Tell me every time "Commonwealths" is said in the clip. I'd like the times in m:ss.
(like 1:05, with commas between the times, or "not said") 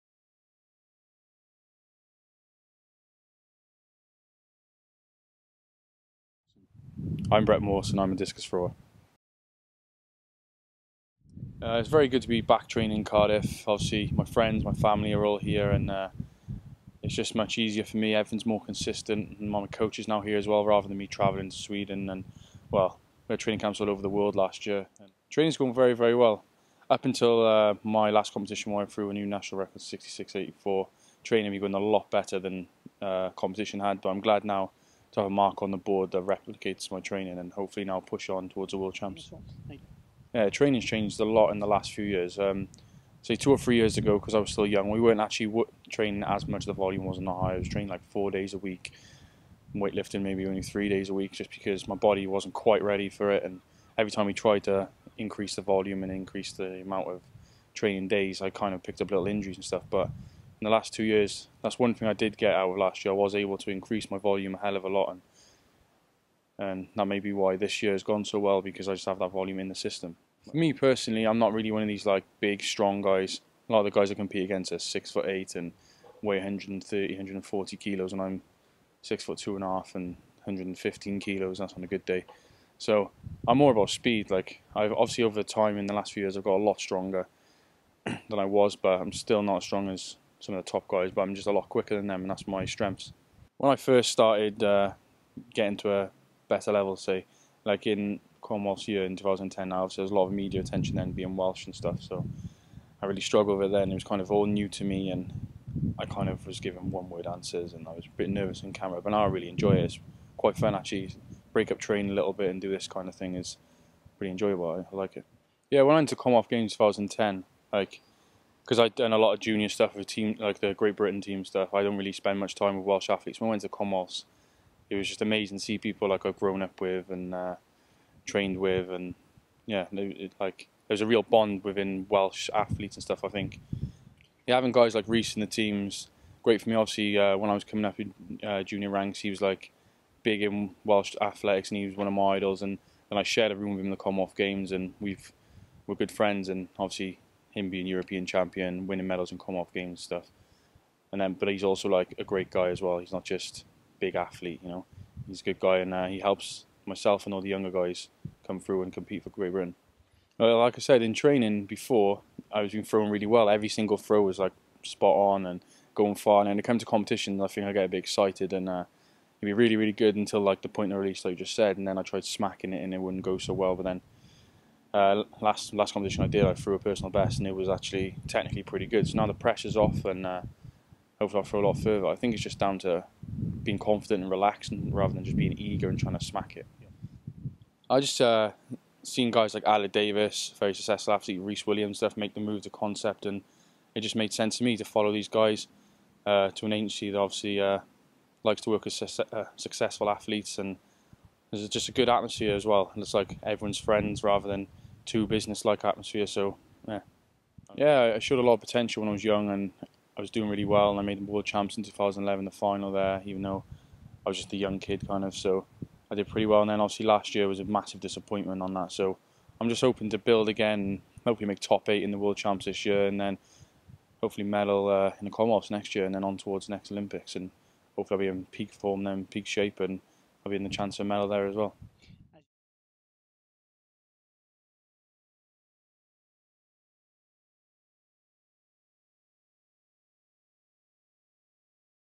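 1:38, 1:56, 2:03, 2:23, 2:29, 3:45.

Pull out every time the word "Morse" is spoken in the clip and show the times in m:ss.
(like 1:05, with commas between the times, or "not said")
0:07.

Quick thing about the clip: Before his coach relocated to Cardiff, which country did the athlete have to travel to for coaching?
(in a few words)
Sweden.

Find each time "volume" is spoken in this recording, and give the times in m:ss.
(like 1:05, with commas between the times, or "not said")
0:46, 0:55, 1:04, 1:09.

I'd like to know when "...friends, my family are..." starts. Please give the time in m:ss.
0:14.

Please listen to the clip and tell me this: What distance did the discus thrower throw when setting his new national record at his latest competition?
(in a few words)
66.84.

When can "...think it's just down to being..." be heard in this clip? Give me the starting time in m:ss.
3:02.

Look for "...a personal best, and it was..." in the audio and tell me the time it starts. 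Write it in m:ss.
2:56.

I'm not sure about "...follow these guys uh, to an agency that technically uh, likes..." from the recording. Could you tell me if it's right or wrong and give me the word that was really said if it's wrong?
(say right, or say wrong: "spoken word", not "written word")
wrong: "obviously", not "technically".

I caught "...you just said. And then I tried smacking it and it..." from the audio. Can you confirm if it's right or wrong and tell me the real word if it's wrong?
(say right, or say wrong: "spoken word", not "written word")
right.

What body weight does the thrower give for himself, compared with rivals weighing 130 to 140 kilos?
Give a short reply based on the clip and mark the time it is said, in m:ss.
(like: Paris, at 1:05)
115 kilos, at 1:20.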